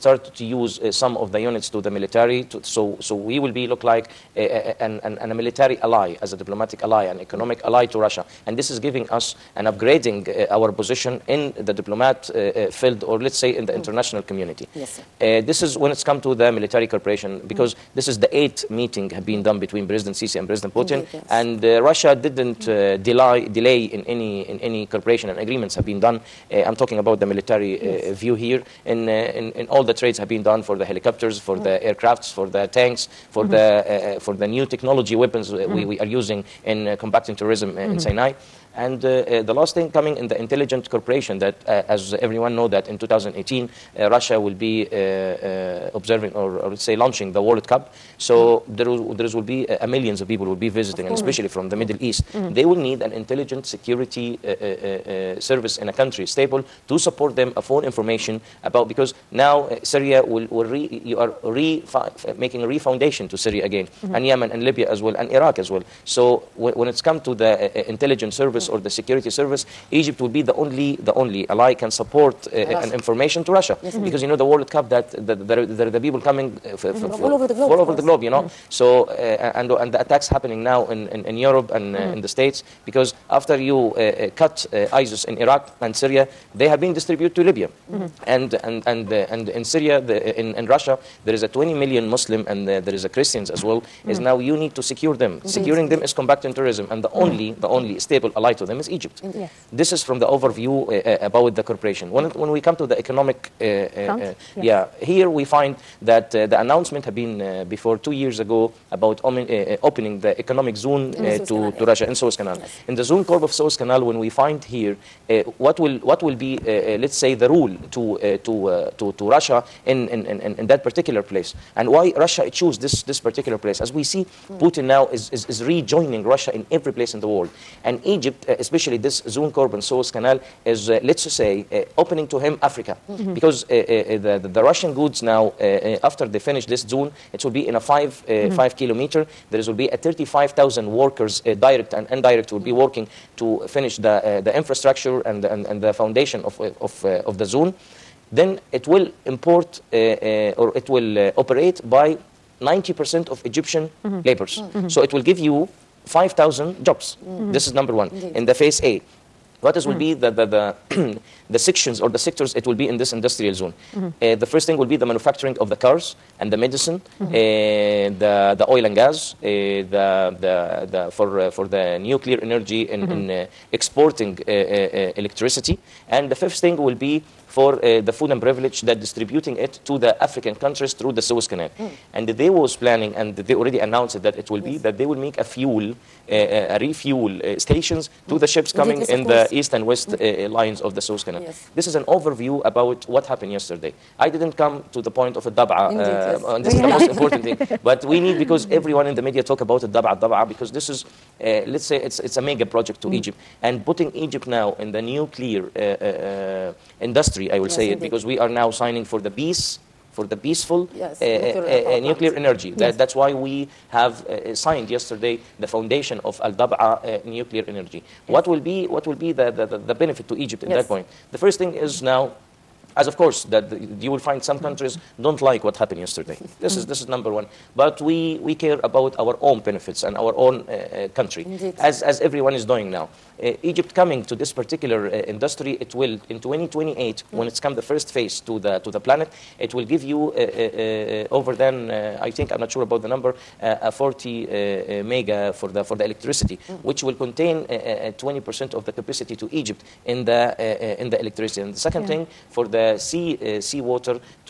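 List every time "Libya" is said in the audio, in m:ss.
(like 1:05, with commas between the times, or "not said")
1:04, 1:27.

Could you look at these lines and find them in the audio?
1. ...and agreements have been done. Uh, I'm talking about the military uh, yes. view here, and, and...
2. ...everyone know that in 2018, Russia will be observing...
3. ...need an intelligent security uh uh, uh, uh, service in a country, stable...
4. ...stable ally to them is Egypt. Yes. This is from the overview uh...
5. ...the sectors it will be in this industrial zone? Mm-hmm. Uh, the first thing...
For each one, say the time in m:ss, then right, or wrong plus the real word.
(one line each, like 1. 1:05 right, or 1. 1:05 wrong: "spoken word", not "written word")
1. 0:25 right
2. 0:42 right
3. 0:52 right
4. 1:38 right
5. 2:42 right.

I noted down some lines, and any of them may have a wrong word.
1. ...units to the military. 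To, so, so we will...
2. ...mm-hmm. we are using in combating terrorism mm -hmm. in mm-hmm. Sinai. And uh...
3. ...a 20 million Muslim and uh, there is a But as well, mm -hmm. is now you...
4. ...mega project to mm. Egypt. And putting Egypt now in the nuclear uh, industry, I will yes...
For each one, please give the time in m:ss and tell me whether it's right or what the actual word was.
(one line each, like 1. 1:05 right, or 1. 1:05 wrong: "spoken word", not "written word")
1. 0:01 right
2. 0:35 right
3. 1:31 wrong: "Christians", not "But"
4. 3:22 right.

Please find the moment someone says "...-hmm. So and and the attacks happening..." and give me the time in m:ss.
1:18.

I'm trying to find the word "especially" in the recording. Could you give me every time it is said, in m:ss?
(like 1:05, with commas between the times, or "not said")
0:51, 2:08.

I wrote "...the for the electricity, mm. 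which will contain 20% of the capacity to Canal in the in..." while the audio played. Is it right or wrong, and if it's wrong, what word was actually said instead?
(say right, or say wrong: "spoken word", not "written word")
wrong: "Egypt", not "Canal".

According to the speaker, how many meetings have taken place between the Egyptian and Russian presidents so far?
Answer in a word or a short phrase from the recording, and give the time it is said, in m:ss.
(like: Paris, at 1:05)
8, at 0:18.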